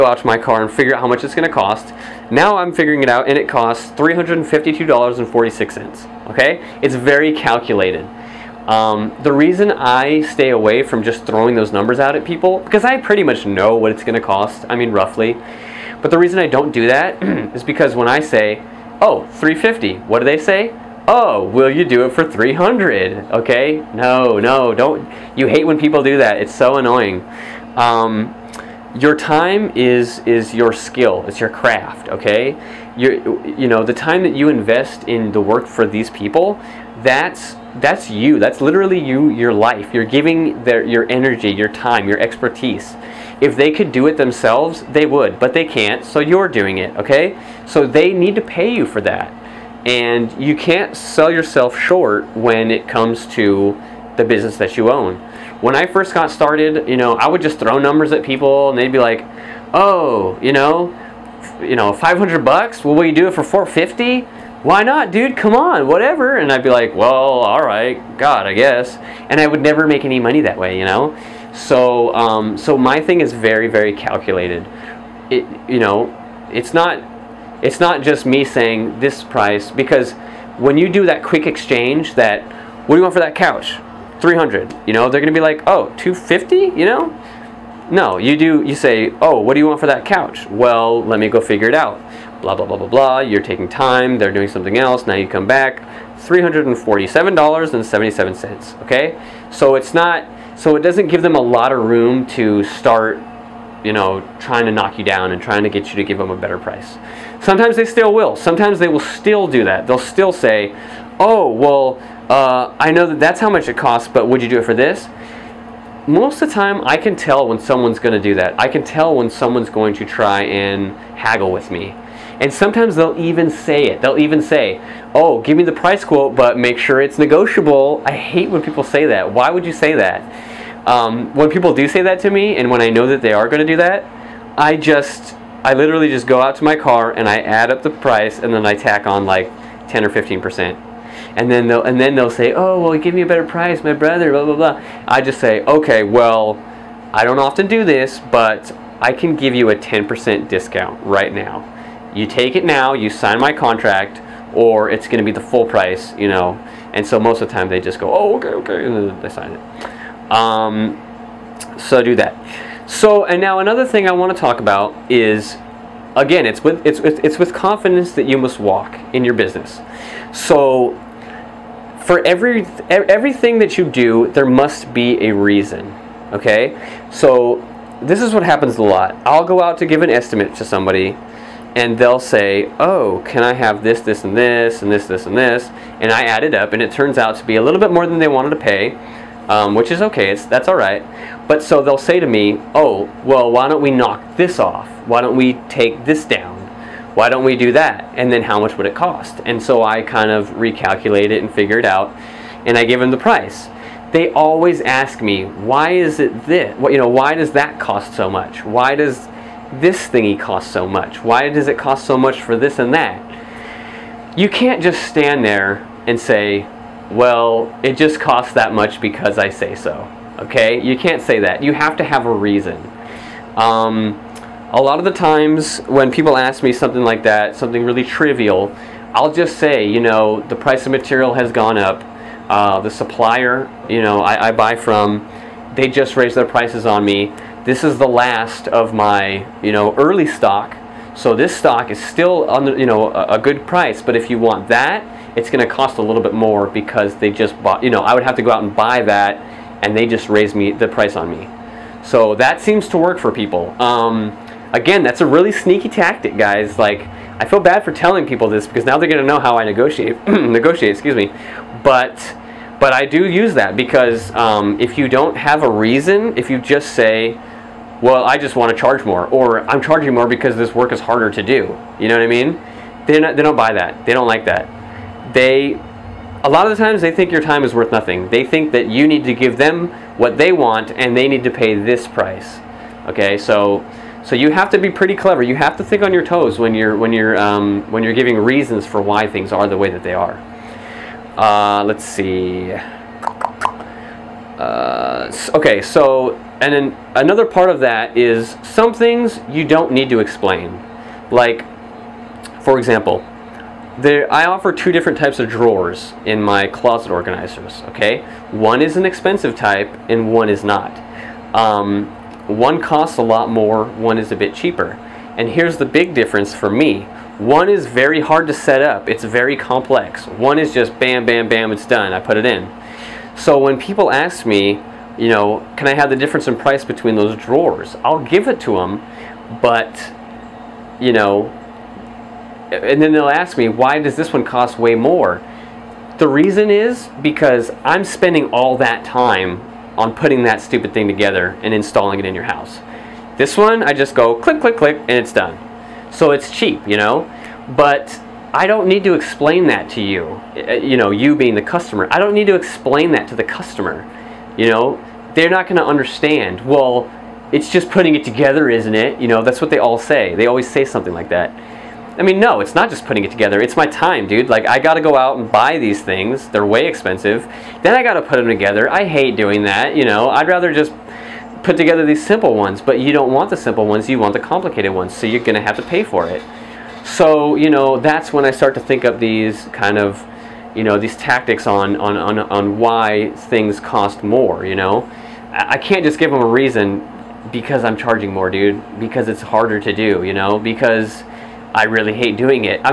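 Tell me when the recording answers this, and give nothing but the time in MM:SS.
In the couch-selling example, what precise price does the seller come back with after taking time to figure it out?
01:36.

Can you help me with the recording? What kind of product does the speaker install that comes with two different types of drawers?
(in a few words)
closet organizers.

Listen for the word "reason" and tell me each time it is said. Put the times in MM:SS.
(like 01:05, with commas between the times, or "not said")
00:09, 00:16, 02:55, 03:42, 04:25, 04:48, 05:36, 06:26.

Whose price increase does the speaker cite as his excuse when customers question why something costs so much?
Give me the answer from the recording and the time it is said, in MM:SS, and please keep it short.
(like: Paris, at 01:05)
the supplier, at 03:52.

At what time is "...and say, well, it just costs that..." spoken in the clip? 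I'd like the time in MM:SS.
03:36.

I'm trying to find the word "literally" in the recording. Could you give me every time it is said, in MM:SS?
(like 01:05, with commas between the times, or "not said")
00:38, 02:15.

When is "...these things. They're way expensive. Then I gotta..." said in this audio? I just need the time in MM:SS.
06:05.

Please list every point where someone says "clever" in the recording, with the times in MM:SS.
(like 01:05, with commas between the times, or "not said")
04:45.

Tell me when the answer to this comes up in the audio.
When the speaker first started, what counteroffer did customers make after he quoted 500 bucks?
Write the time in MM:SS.
01:03.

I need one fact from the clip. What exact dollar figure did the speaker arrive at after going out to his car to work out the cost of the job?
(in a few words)
$352.46.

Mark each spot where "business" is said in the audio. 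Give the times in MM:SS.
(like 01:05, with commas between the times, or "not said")
00:54, 02:49.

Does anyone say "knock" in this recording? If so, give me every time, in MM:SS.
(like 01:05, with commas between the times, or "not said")
01:44, 03:13.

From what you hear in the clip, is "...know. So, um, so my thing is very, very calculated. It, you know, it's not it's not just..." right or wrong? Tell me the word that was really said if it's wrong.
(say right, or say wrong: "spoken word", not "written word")
right.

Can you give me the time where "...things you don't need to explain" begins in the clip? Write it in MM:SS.
04:58.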